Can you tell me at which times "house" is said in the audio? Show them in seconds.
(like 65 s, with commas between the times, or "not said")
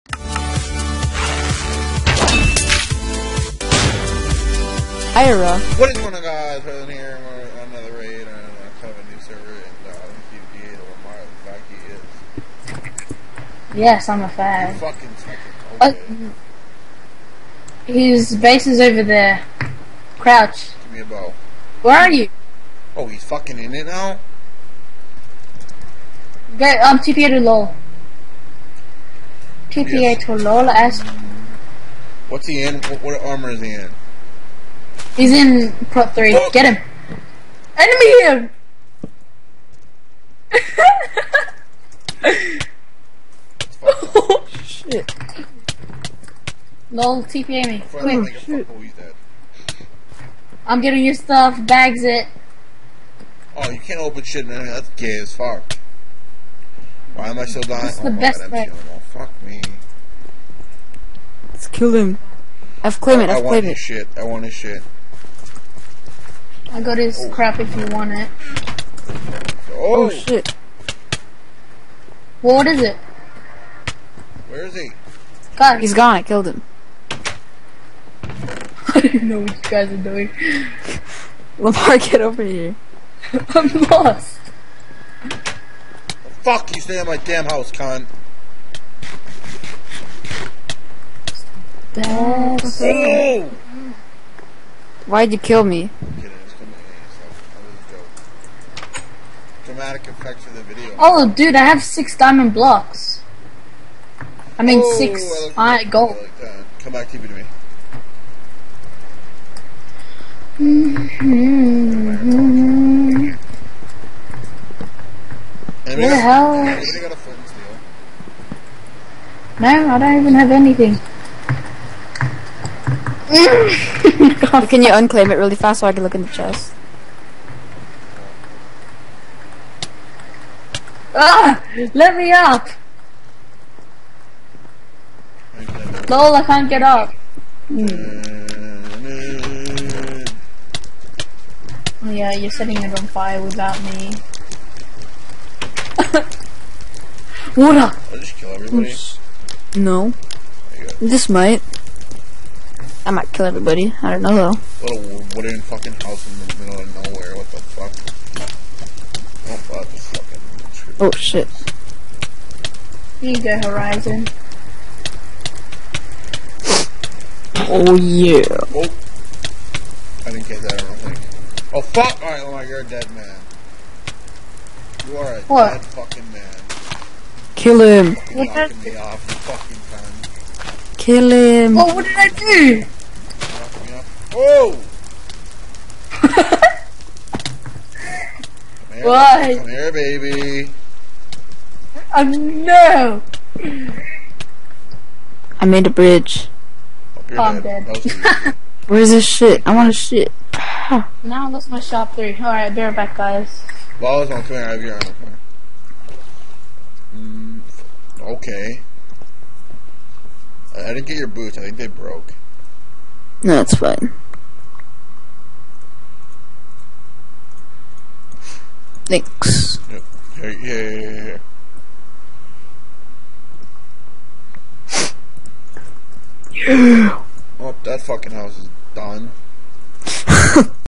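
87 s, 155 s, 228 s.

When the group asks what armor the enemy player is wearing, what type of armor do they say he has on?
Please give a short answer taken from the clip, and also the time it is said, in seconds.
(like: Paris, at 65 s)
Prot three, at 35 s.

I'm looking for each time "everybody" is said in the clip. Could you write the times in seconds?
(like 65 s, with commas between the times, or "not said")
148 s, 153 s.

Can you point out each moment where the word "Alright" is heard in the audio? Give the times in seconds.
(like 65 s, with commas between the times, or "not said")
172 s, 202 s.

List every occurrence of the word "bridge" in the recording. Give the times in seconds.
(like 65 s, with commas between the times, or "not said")
195 s.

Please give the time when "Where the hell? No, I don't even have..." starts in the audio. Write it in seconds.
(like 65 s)
115 s.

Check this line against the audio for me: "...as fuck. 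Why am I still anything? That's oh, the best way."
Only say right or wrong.
wrong.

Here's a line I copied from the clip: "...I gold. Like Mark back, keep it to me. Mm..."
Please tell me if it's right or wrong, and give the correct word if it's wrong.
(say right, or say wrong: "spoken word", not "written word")
wrong: "Come", not "Mark".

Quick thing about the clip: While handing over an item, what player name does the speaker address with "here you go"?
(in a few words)
Horizon.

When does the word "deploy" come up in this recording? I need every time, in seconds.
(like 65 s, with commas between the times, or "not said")
not said.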